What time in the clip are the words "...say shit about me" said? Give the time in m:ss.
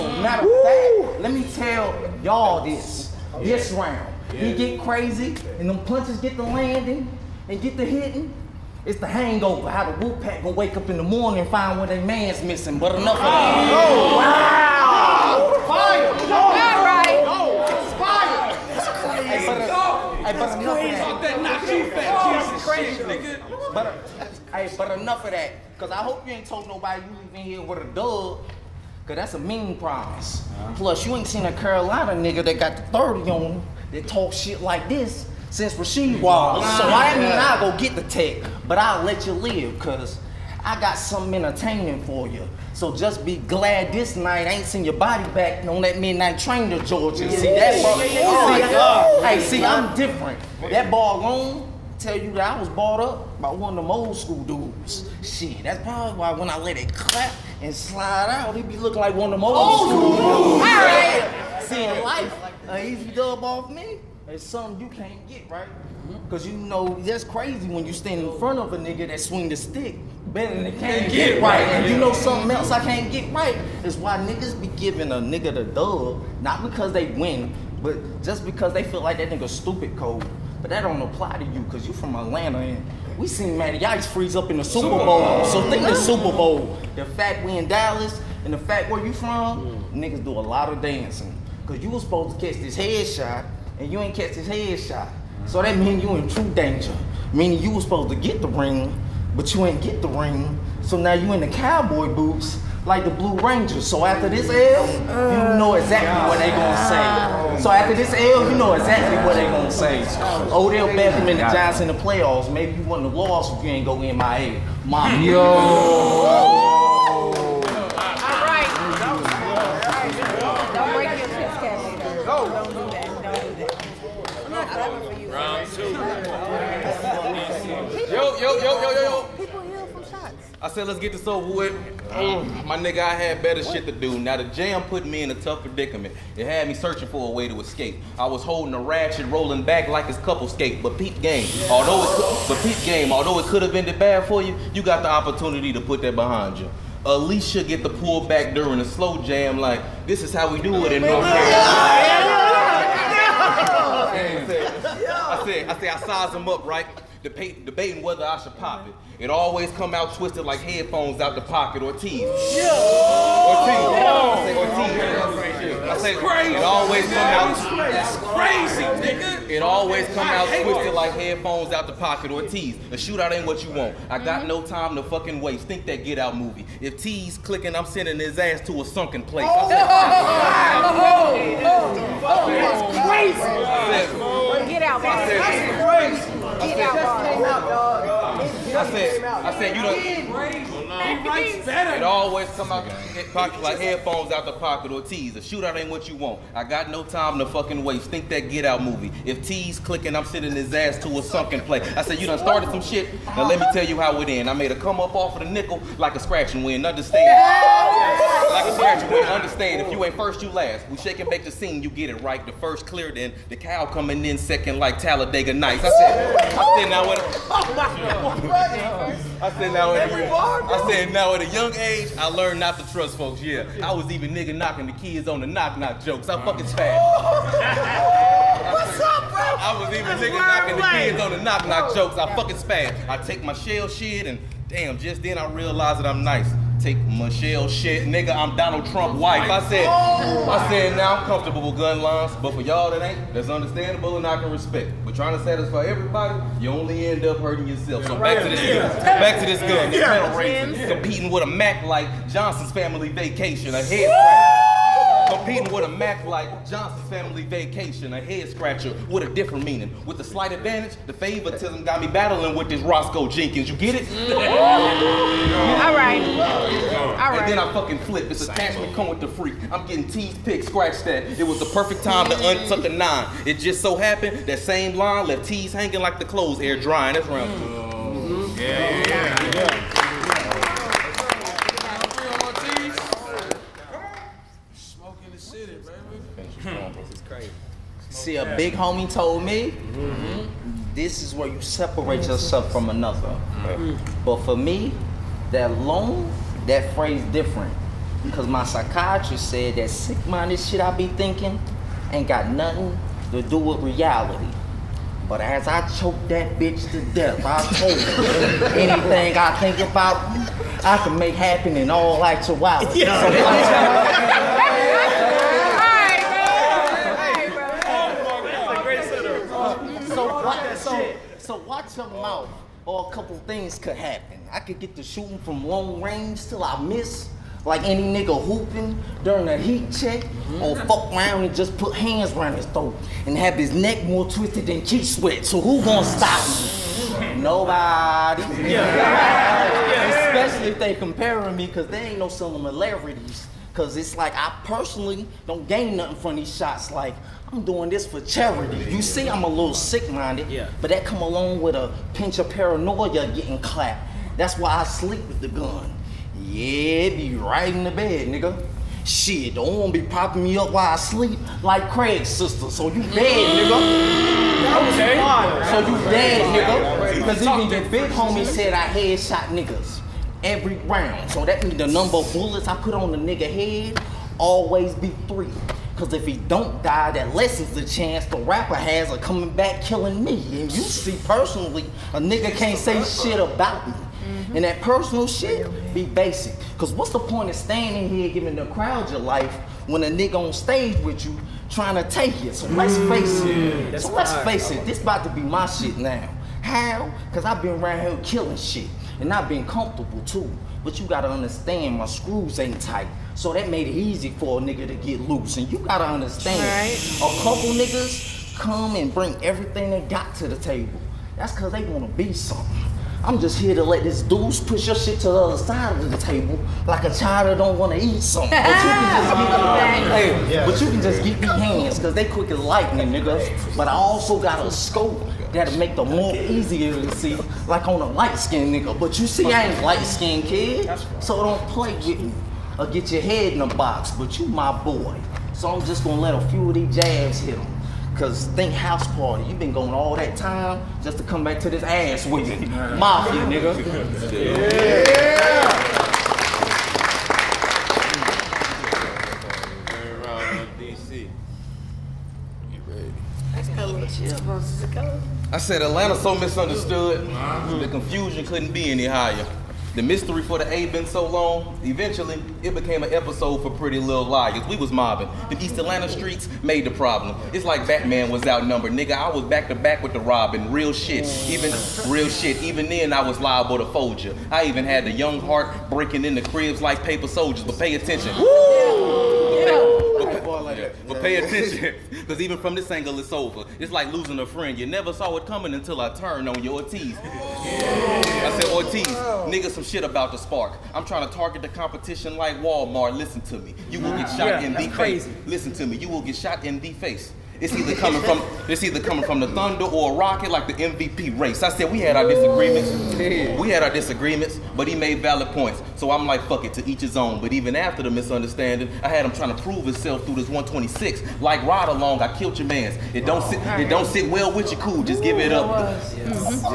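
6:22.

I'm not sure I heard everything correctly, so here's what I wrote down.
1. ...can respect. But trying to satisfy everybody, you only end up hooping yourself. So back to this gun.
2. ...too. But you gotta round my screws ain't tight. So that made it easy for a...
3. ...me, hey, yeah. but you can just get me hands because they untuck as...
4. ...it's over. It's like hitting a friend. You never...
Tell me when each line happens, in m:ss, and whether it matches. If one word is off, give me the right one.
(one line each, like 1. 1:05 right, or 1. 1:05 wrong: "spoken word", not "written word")
1. 4:04 wrong: "hurting", not "hooping"
2. 6:40 wrong: "understand", not "round"
3. 7:00 wrong: "quick", not "untuck"
4. 8:03 wrong: "losing", not "hitting".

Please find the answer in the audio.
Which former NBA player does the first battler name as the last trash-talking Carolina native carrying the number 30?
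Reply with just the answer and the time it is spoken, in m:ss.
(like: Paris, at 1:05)
Rasheed Wallace, at 0:35.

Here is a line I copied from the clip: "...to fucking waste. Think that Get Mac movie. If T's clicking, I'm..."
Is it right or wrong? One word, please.
wrong.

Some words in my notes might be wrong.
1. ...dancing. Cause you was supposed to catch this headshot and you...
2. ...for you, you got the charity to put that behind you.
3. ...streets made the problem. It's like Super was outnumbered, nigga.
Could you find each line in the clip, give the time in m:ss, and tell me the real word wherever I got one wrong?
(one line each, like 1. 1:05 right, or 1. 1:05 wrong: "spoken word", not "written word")
1. 1:30 right
2. 2:24 wrong: "opportunity", not "charity"
3. 7:46 wrong: "Batman", not "Super".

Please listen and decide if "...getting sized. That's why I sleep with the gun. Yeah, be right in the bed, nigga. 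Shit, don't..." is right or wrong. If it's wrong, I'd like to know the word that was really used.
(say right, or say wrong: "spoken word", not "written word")
wrong: "clapped", not "sized".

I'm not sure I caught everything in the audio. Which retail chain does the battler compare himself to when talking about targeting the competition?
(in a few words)
Walmart.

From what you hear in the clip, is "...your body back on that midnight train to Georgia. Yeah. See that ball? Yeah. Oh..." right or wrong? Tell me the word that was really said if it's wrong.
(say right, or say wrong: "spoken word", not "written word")
right.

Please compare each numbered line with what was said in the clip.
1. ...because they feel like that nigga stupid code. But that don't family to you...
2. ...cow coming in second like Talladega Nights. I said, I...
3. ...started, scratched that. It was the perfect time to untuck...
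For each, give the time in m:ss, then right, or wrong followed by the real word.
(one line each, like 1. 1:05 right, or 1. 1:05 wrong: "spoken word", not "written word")
1. 1:18 wrong: "apply", not "family"
2. 3:33 right
3. 4:30 wrong: "picked", not "started".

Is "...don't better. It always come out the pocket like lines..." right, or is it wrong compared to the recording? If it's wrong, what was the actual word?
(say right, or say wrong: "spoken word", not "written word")
wrong: "headphones", not "lines".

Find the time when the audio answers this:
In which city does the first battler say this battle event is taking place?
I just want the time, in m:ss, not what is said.
1:27.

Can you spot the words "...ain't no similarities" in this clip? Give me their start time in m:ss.
5:42.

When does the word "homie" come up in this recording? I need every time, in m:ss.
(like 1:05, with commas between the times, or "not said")
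4:48, 6:08.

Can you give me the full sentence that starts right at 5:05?
But as I choke that bitch to death, I told her anything I think about, I can make happen in all actuality.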